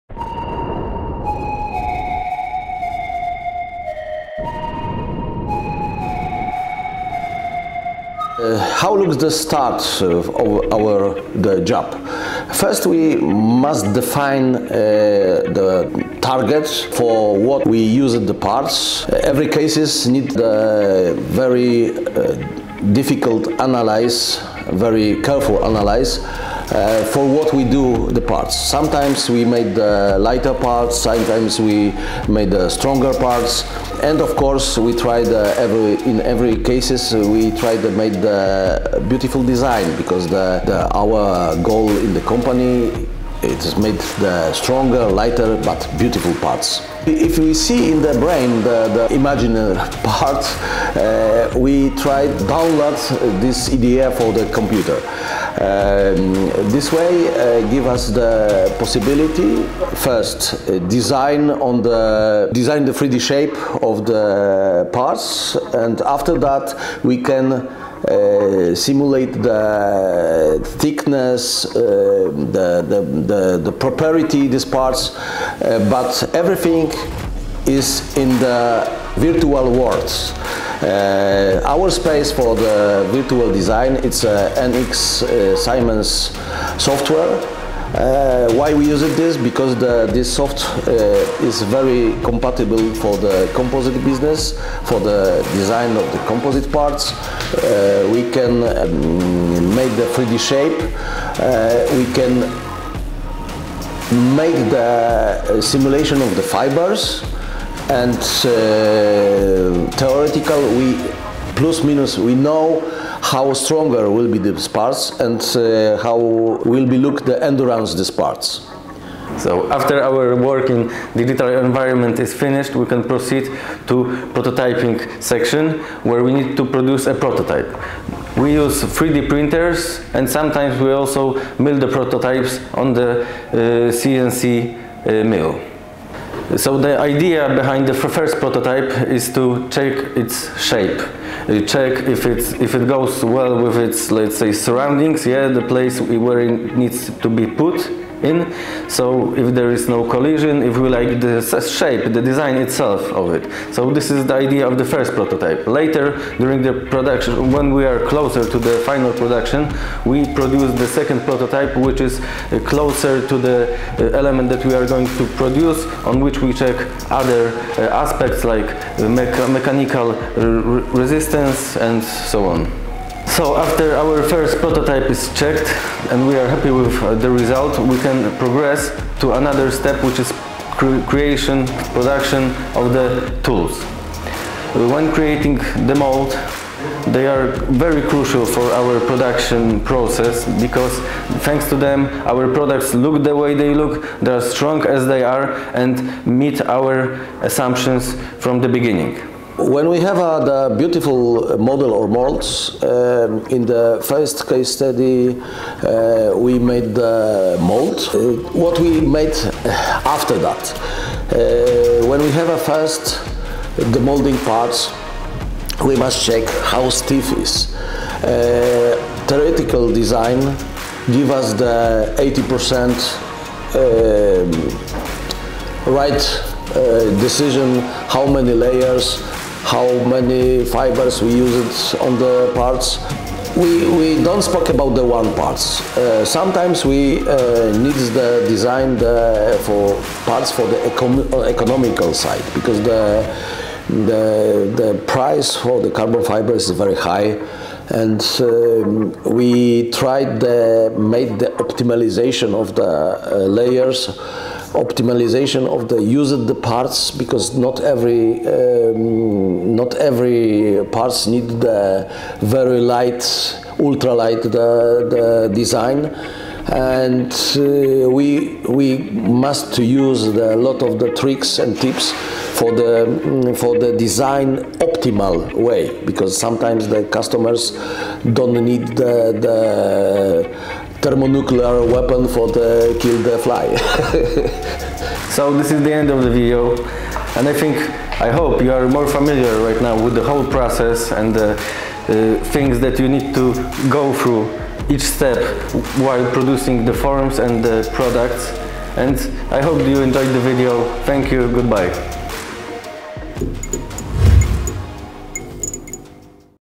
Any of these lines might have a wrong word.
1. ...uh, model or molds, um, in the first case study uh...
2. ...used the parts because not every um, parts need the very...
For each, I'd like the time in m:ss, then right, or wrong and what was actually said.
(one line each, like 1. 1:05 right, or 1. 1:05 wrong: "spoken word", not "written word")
1. 3:21 right
2. 4:16 right.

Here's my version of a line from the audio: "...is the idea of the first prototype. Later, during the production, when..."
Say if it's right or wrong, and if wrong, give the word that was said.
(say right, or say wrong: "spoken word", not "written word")
right.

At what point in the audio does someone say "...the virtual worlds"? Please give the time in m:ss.
1:18.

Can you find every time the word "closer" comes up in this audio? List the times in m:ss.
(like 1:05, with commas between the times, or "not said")
2:38, 2:42.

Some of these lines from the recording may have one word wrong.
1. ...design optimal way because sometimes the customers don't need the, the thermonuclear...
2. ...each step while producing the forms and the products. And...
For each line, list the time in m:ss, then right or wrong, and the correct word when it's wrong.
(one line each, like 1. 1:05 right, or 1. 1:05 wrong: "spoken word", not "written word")
1. 4:33 right
2. 4:54 right.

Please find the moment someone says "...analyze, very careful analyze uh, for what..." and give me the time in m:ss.
0:23.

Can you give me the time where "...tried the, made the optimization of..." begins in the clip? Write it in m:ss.
4:09.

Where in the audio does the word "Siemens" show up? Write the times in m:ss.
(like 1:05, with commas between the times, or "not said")
1:25.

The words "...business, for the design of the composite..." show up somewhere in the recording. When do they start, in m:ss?
1:34.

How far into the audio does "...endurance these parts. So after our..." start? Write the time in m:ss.
1:57.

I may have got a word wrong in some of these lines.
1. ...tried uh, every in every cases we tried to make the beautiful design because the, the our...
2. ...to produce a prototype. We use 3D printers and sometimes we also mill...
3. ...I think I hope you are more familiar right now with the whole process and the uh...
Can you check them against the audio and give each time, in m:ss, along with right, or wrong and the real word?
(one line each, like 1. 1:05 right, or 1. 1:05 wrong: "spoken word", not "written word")
1. 0:34 right
2. 2:06 right
3. 4:47 right.